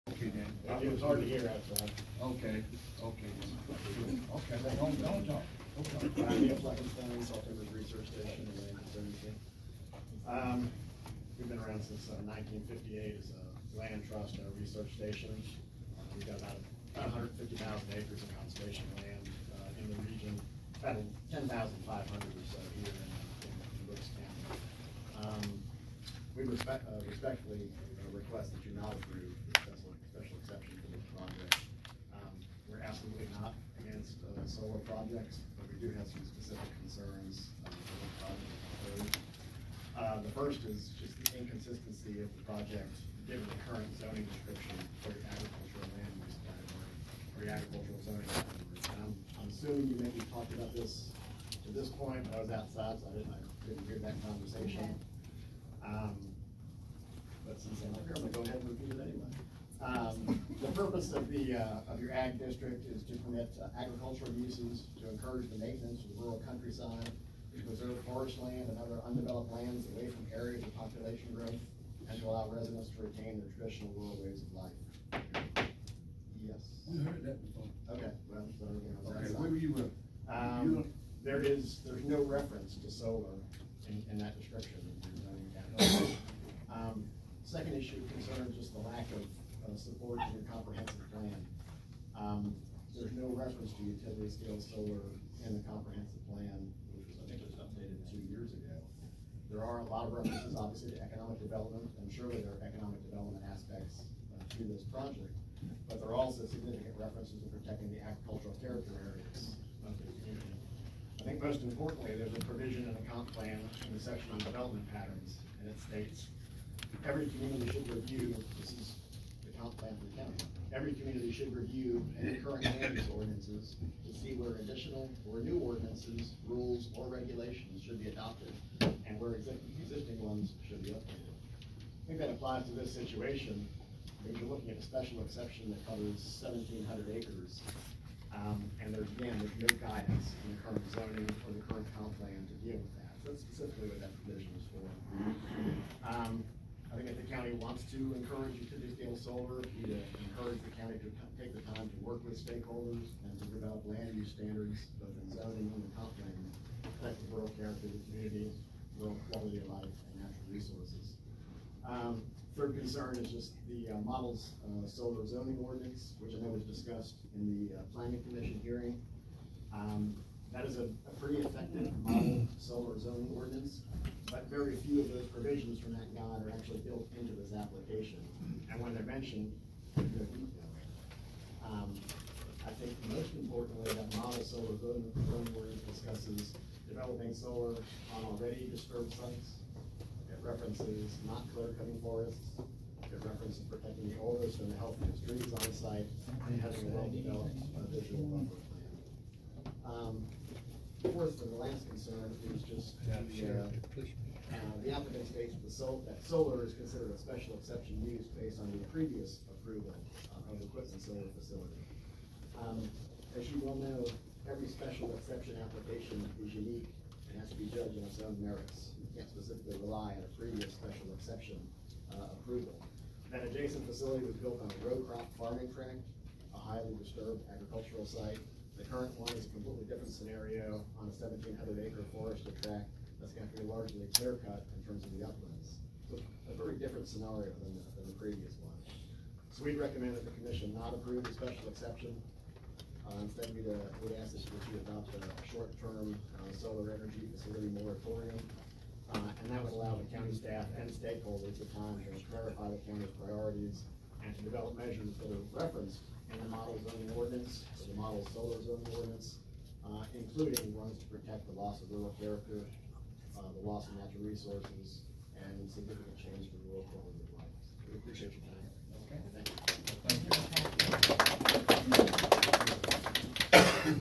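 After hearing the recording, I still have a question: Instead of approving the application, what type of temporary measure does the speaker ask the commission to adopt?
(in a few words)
solar energy facility moratorium.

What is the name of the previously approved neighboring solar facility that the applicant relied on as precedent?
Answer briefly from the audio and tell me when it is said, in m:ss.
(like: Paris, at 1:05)
Quitman, at 3:30.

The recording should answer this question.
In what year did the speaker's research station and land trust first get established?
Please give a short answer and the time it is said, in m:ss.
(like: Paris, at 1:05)
1958, at 0:12.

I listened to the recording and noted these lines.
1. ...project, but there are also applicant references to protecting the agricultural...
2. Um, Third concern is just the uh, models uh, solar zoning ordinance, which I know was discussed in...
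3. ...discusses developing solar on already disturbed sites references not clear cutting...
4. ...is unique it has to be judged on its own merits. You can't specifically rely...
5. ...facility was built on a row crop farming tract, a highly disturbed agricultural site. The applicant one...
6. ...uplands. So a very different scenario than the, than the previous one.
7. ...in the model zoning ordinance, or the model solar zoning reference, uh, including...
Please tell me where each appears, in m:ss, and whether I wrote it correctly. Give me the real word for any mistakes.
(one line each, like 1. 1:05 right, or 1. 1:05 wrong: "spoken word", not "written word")
1. 1:44 wrong: "significant", not "applicant"
2. 2:41 right
3. 3:05 right
4. 3:36 right
5. 3:43 wrong: "current", not "applicant"
6. 3:55 right
7. 4:16 wrong: "ordinance", not "reference".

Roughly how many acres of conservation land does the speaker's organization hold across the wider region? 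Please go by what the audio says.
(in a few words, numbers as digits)
150,000 acres.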